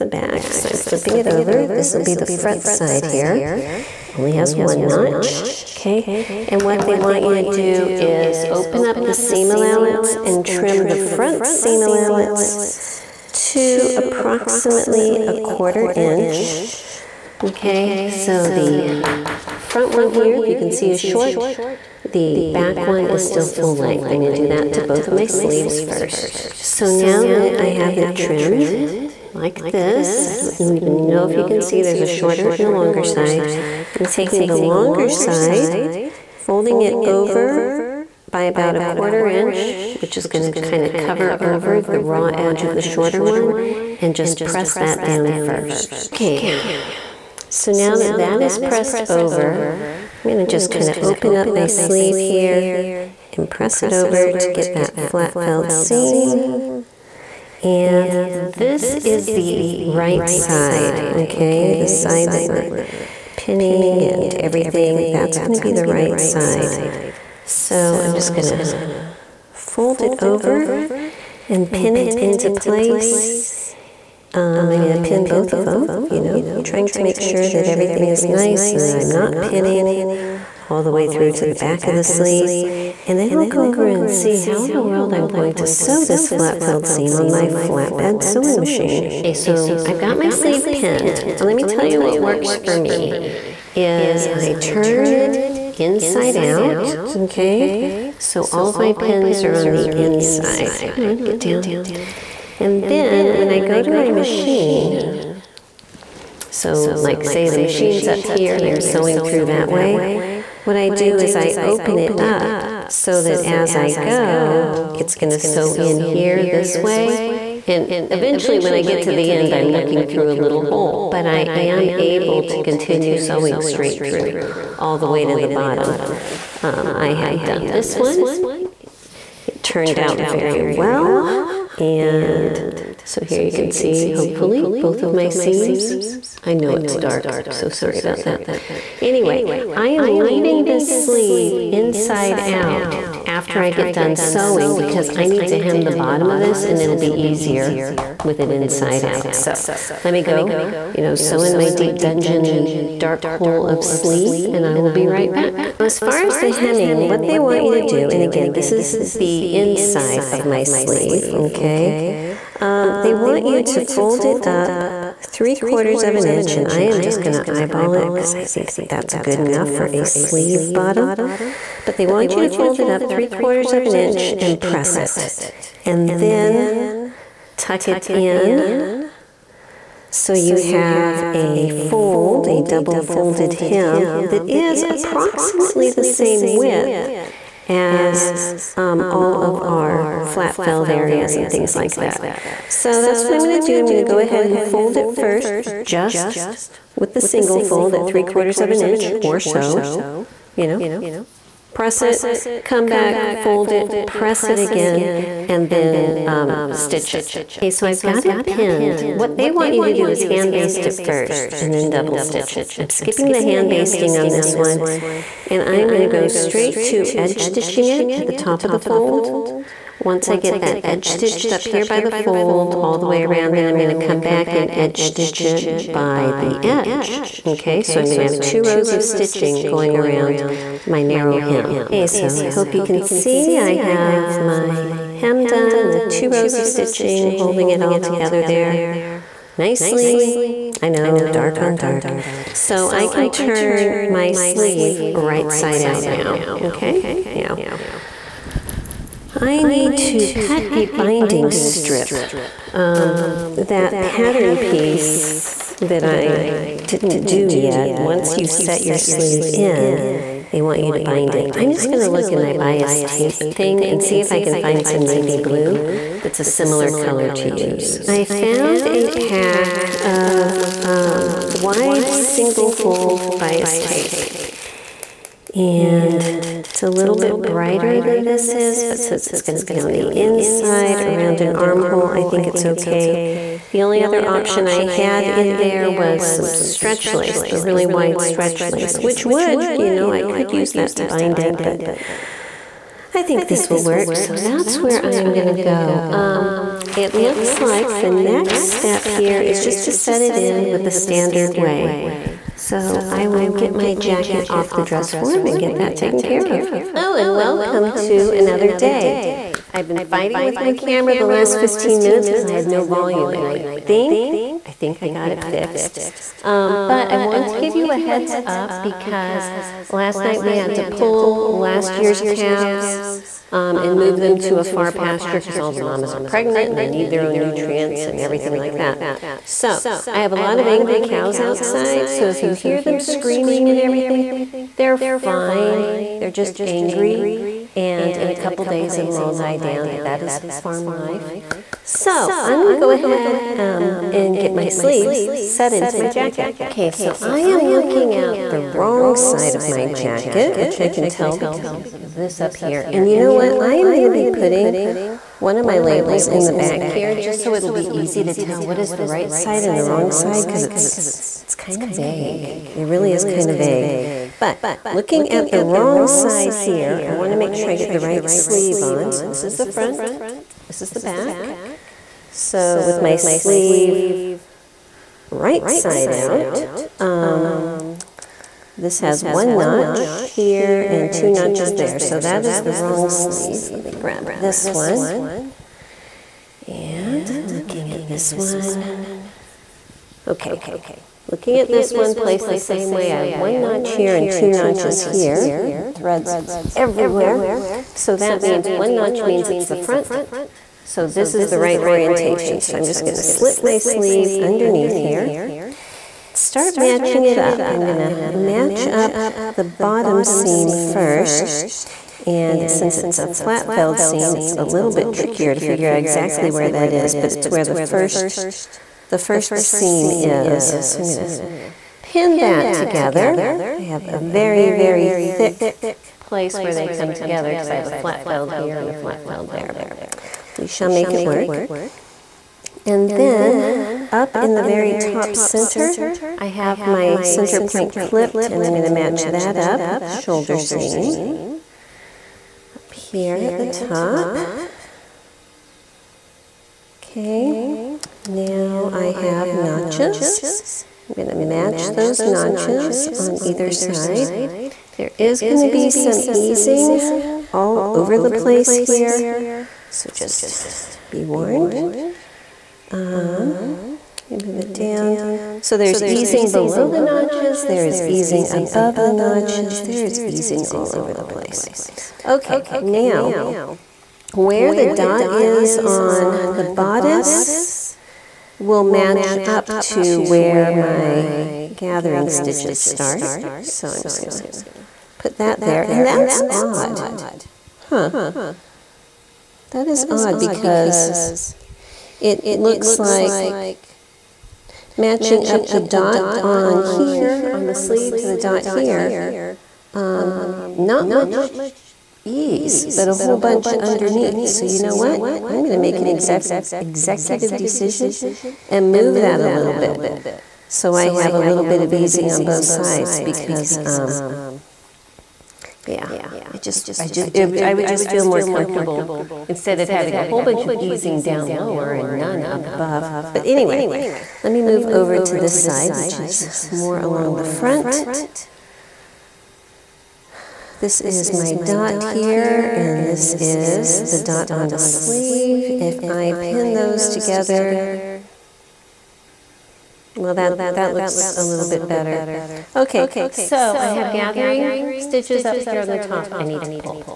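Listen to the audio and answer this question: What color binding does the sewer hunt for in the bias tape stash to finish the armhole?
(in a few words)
Navy blue.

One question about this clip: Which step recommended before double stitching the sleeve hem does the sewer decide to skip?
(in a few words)
Hand basting.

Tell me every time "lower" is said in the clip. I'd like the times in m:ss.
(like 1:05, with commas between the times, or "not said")
8:41.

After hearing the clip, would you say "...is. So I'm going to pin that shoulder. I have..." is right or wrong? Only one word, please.
wrong.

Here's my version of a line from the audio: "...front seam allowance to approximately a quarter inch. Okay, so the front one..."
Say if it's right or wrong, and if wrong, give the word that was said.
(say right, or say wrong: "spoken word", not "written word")
right.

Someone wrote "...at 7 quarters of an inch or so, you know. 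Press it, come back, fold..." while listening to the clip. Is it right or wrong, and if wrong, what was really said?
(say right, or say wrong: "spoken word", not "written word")
wrong: "3", not "7".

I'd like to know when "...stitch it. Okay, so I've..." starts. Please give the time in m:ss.
3:26.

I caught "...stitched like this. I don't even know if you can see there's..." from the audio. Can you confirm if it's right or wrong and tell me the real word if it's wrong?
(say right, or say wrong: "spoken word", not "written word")
wrong: "trimmed", not "stitched".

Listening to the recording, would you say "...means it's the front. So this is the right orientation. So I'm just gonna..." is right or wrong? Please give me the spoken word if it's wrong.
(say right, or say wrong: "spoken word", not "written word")
right.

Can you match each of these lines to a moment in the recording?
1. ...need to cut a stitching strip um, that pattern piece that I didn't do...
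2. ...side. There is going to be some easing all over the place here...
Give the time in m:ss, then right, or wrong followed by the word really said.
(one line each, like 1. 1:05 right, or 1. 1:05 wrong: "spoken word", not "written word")
1. 4:09 wrong: "binding", not "stitching"
2. 7:33 right.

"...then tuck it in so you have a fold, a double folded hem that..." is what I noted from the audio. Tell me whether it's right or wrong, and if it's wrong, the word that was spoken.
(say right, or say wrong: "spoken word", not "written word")
right.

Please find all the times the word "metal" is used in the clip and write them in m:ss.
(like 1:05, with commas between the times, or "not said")
not said.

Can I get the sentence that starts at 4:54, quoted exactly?
So that's where I am gonna go.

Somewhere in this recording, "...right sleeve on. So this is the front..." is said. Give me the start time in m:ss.
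6:07.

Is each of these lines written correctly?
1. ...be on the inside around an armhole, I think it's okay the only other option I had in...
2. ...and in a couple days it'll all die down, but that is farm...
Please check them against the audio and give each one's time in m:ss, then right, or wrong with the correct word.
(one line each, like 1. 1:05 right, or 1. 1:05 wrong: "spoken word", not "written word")
1. 4:39 right
2. 5:37 right.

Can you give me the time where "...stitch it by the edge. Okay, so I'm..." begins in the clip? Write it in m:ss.
3:45.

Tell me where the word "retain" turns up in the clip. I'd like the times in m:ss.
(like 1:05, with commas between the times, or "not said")
not said.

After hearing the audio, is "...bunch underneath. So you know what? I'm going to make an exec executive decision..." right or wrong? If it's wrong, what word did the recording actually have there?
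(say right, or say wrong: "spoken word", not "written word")
right.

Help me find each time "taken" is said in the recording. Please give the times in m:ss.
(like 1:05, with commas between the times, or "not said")
5:05.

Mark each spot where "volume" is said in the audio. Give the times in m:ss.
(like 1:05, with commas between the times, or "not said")
5:12.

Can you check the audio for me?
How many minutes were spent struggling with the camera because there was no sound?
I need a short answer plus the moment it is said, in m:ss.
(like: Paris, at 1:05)
15, at 5:11.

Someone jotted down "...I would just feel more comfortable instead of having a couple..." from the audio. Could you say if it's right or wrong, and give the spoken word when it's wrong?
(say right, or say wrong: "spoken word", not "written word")
wrong: "whole", not "couple".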